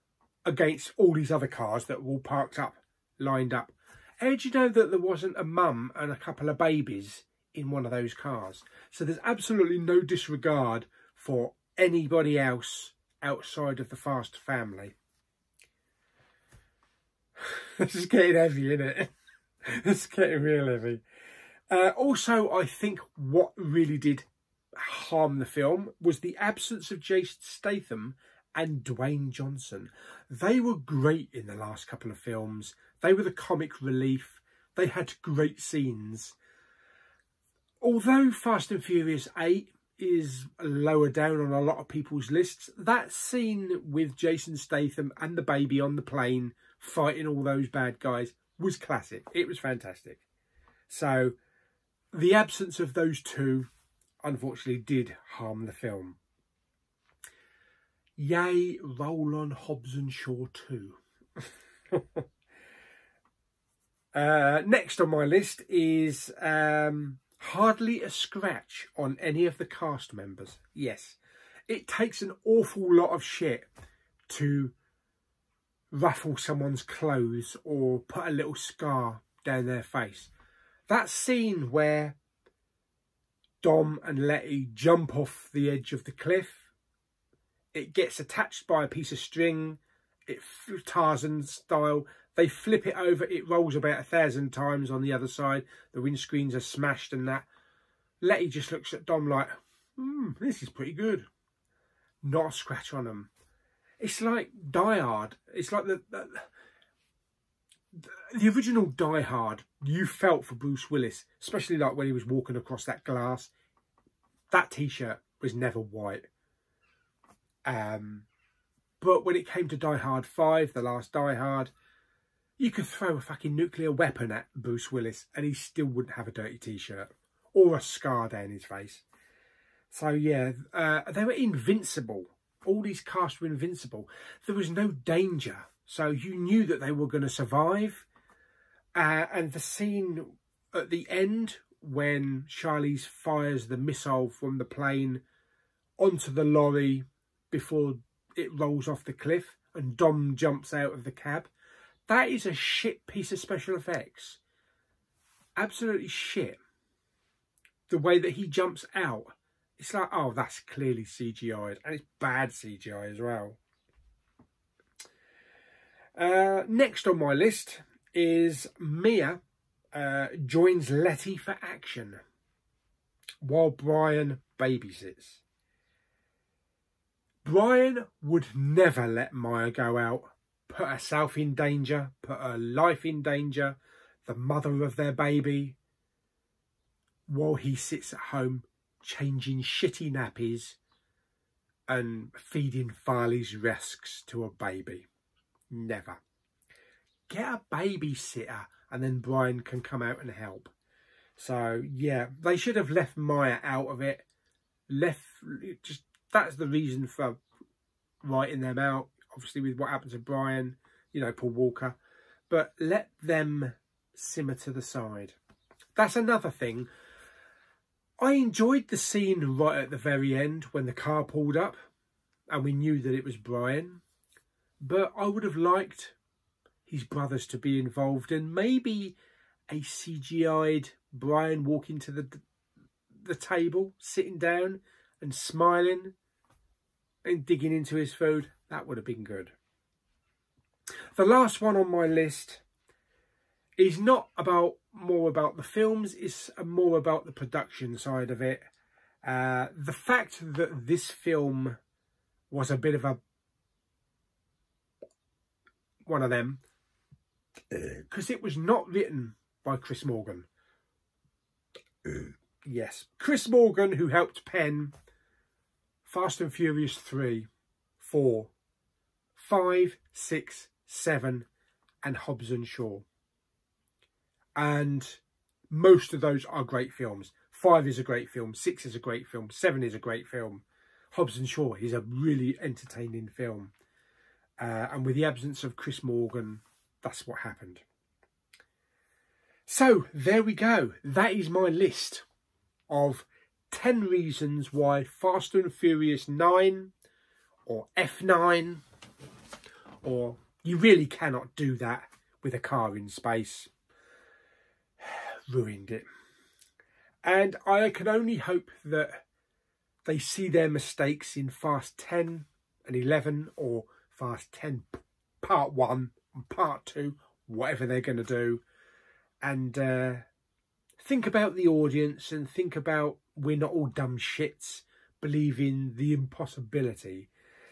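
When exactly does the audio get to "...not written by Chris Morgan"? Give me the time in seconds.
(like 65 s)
258 s.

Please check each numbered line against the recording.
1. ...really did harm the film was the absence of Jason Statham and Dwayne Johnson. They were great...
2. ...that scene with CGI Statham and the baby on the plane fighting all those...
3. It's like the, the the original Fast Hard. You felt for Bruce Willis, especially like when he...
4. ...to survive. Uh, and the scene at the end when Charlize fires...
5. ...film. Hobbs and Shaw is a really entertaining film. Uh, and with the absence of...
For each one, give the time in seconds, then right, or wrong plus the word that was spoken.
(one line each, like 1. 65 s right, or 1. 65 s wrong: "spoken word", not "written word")
1. 23 s right
2. 42 s wrong: "Jason", not "CGI"
3. 105 s wrong: "Die", not "Fast"
4. 137 s right
5. 280 s right.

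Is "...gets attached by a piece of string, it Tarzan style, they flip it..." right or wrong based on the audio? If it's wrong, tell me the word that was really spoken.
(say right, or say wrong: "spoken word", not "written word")
right.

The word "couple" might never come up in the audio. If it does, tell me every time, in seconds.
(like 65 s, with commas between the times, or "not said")
6 s, 31 s.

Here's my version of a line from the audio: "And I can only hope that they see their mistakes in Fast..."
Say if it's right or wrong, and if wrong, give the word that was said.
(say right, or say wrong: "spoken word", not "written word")
right.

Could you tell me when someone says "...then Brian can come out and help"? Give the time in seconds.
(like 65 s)
199 s.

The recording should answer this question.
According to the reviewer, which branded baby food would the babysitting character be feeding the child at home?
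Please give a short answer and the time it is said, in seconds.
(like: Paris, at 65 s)
Farley's Rusks, at 193 s.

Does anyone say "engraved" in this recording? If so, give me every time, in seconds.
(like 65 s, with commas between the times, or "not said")
not said.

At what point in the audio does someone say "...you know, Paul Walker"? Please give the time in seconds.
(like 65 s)
211 s.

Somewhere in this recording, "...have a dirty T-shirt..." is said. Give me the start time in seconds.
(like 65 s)
126 s.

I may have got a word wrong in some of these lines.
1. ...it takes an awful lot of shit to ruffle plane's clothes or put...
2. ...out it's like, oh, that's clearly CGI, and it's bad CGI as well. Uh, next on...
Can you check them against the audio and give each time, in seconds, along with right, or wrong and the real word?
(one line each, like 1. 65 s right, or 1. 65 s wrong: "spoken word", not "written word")
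1. 71 s wrong: "someone", not "plane"
2. 158 s right.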